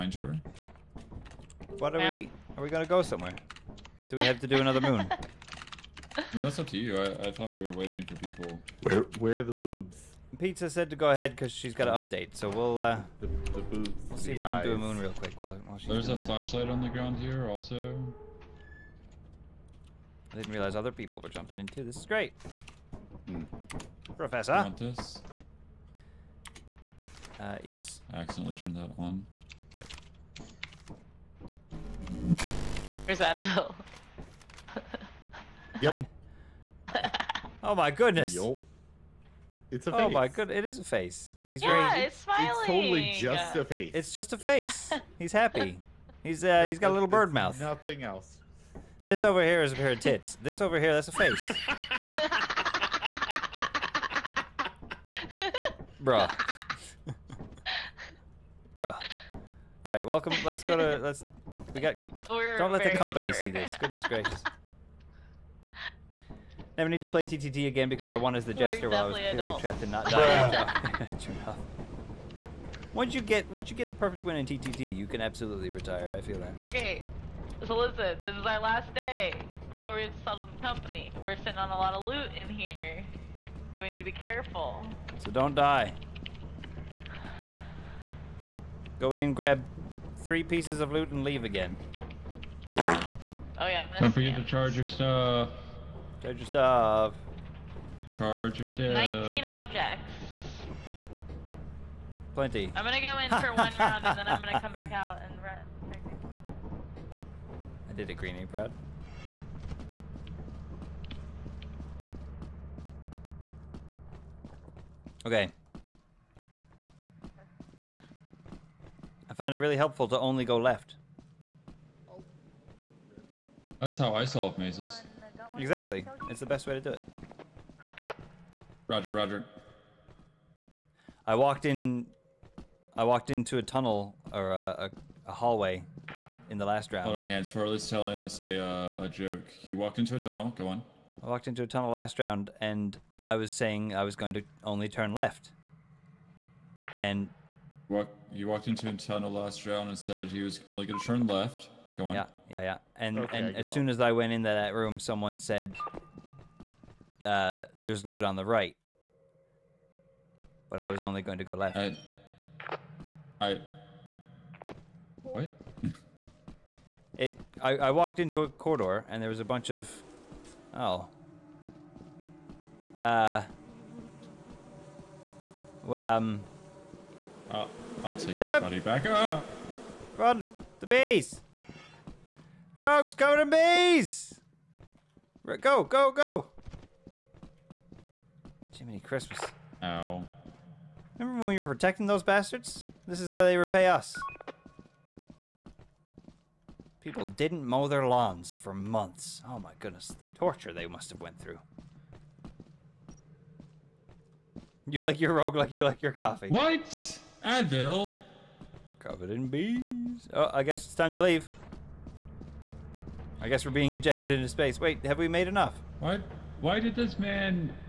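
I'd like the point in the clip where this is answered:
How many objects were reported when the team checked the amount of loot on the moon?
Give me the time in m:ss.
1:38.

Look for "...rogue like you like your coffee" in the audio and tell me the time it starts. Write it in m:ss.
3:25.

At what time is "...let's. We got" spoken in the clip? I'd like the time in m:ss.
1:00.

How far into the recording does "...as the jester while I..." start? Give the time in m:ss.
1:08.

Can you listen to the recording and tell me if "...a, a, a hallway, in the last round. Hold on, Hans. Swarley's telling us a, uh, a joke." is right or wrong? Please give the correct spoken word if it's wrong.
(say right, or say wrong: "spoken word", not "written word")
right.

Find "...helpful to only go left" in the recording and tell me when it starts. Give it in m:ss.
1:59.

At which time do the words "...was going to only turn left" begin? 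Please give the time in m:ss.
2:24.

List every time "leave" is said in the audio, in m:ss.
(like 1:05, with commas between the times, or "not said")
1:31, 3:31.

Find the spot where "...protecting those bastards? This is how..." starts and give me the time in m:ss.
3:11.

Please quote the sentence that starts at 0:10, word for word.
Pizza said to go ahead because she's got an update, so we'll uh, the, the boobs.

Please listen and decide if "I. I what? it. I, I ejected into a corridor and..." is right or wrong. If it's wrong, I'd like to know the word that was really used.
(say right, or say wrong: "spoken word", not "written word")
wrong: "walked", not "ejected".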